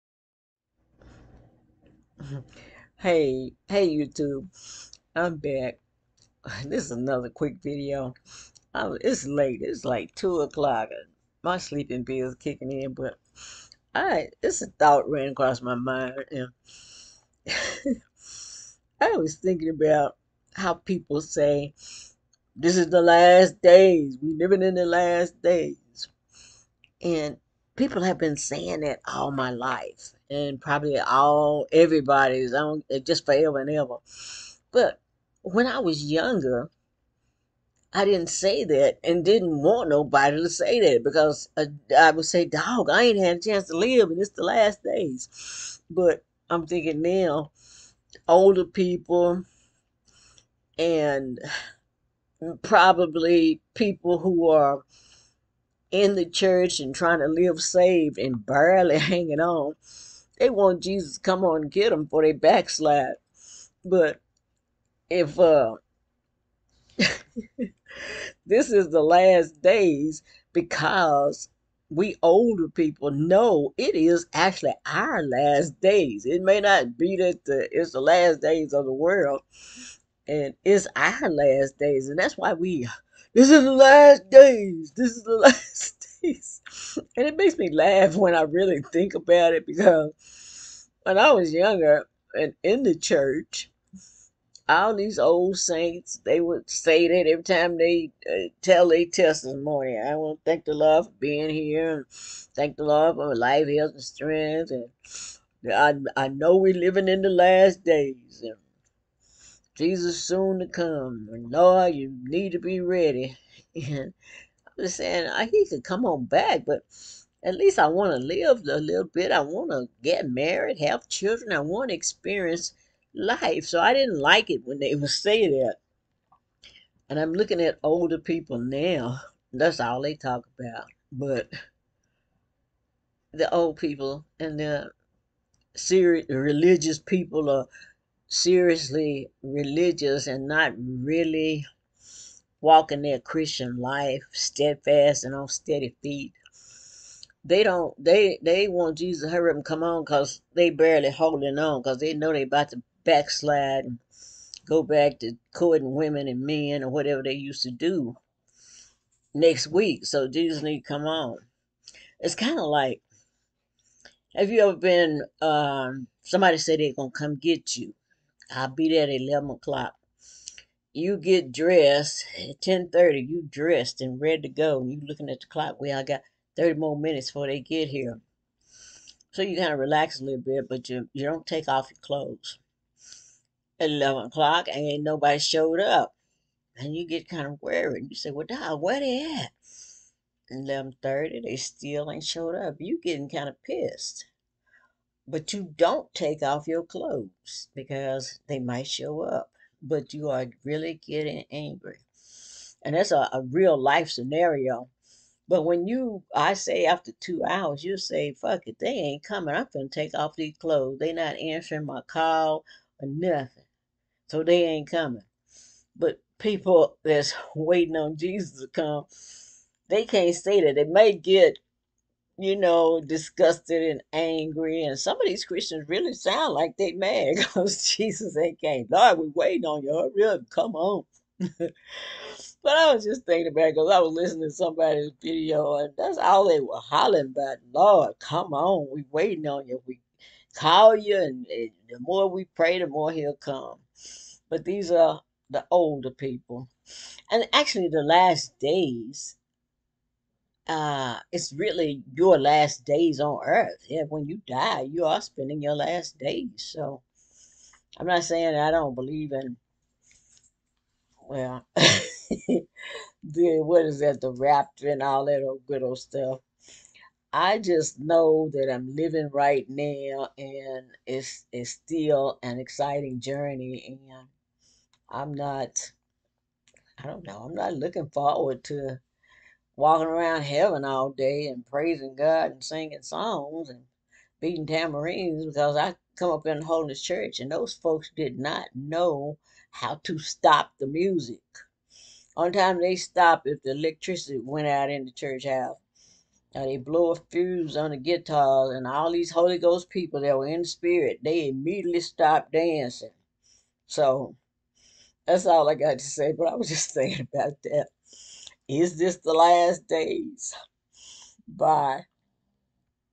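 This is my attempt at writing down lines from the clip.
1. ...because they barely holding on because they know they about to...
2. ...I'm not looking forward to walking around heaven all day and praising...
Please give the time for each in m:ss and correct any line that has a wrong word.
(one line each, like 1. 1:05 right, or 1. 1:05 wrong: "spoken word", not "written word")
1. 2:30 right
2. 4:37 right.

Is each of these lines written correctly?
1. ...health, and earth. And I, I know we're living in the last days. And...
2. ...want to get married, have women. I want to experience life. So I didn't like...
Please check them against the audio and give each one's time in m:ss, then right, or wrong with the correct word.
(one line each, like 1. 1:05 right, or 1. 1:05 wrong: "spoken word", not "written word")
1. 1:43 wrong: "strength", not "earth"
2. 1:59 wrong: "children", not "women".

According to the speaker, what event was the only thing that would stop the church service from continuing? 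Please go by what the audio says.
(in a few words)
the electricity went out.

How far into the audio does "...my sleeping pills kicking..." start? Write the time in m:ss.
0:11.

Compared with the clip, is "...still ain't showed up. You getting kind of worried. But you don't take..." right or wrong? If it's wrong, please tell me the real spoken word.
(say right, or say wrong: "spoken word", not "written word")
wrong: "pissed", not "worried".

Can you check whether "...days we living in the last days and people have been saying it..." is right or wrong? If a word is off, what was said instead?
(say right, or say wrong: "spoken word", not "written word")
right.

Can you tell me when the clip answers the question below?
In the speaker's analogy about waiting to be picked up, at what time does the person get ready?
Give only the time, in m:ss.
2:52.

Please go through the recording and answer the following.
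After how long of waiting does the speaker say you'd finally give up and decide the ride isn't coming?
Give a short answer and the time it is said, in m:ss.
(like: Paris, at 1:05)
2 hours, at 3:27.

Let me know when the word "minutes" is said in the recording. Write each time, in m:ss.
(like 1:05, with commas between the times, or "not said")
2:56.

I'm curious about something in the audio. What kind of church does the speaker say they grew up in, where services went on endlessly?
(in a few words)
Holiness Church.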